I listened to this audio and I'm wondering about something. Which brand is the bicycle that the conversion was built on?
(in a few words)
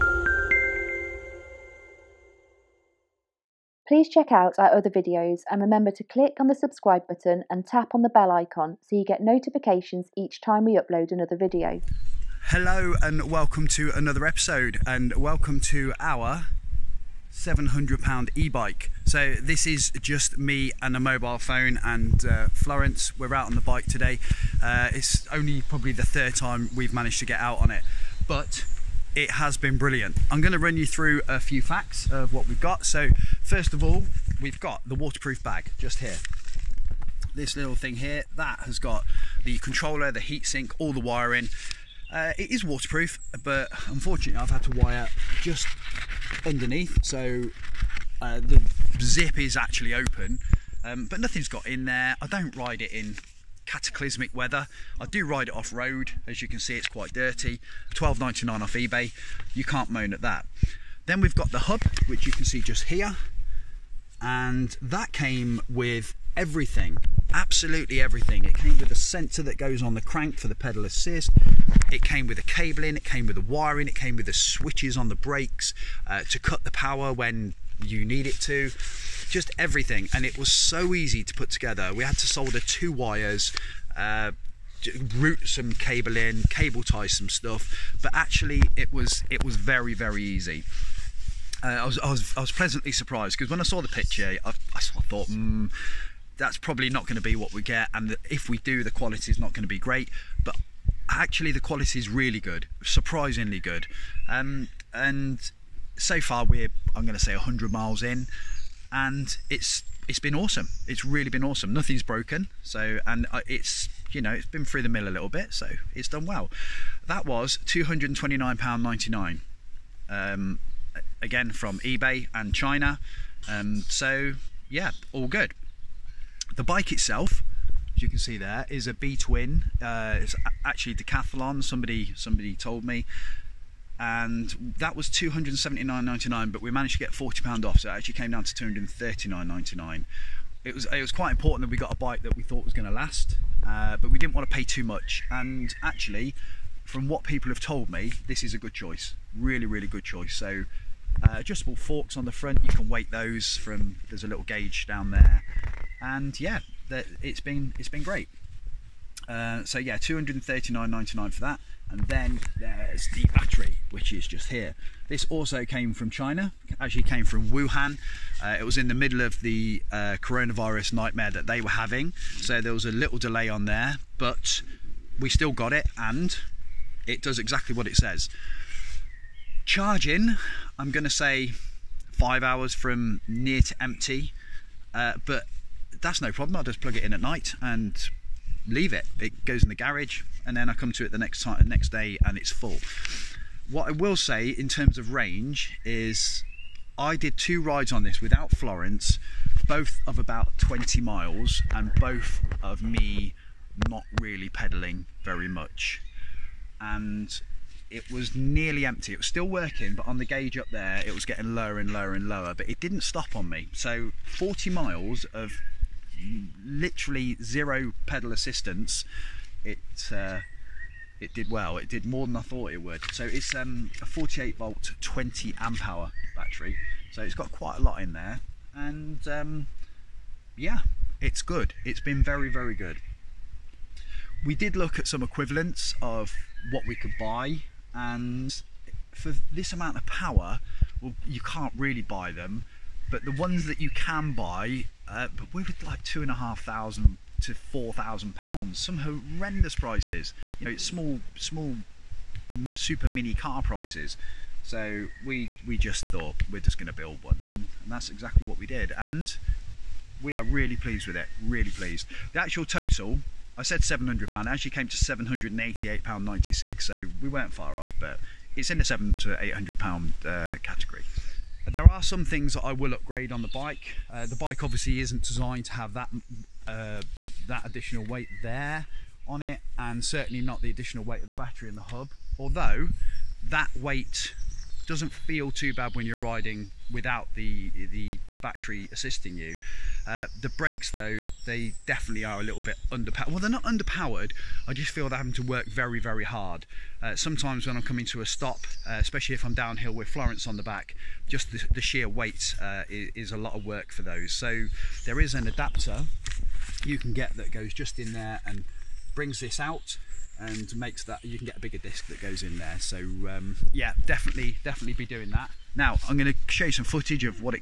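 B'Twin.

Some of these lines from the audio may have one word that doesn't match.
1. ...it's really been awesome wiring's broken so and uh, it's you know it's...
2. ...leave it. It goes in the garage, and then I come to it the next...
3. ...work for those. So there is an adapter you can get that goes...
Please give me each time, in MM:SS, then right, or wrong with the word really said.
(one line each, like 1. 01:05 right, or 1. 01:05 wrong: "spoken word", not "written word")
1. 01:50 wrong: "nothing", not "wiring"
2. 03:08 right
3. 05:03 right.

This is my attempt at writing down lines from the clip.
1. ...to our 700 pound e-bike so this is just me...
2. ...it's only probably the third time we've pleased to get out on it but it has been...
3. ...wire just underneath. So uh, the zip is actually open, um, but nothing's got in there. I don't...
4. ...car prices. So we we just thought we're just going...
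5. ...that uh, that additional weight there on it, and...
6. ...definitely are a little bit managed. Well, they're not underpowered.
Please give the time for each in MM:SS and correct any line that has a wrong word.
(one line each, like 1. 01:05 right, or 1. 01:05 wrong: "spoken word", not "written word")
1. 00:15 right
2. 00:24 wrong: "managed", not "pleased"
3. 00:44 right
4. 04:13 right
5. 04:35 right
6. 04:51 wrong: "underpowered", not "managed".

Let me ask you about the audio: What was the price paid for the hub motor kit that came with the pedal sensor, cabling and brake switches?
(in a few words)
£229.99.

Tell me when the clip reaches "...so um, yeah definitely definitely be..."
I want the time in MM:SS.
05:12.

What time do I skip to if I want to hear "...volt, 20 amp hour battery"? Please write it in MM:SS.
03:44.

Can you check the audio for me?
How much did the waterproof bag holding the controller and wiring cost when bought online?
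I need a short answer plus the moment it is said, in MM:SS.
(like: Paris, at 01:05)
£12.99, at 00:57.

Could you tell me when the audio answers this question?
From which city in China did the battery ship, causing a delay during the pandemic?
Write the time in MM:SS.
02:47.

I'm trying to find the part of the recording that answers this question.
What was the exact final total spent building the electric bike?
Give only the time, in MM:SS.
04:24.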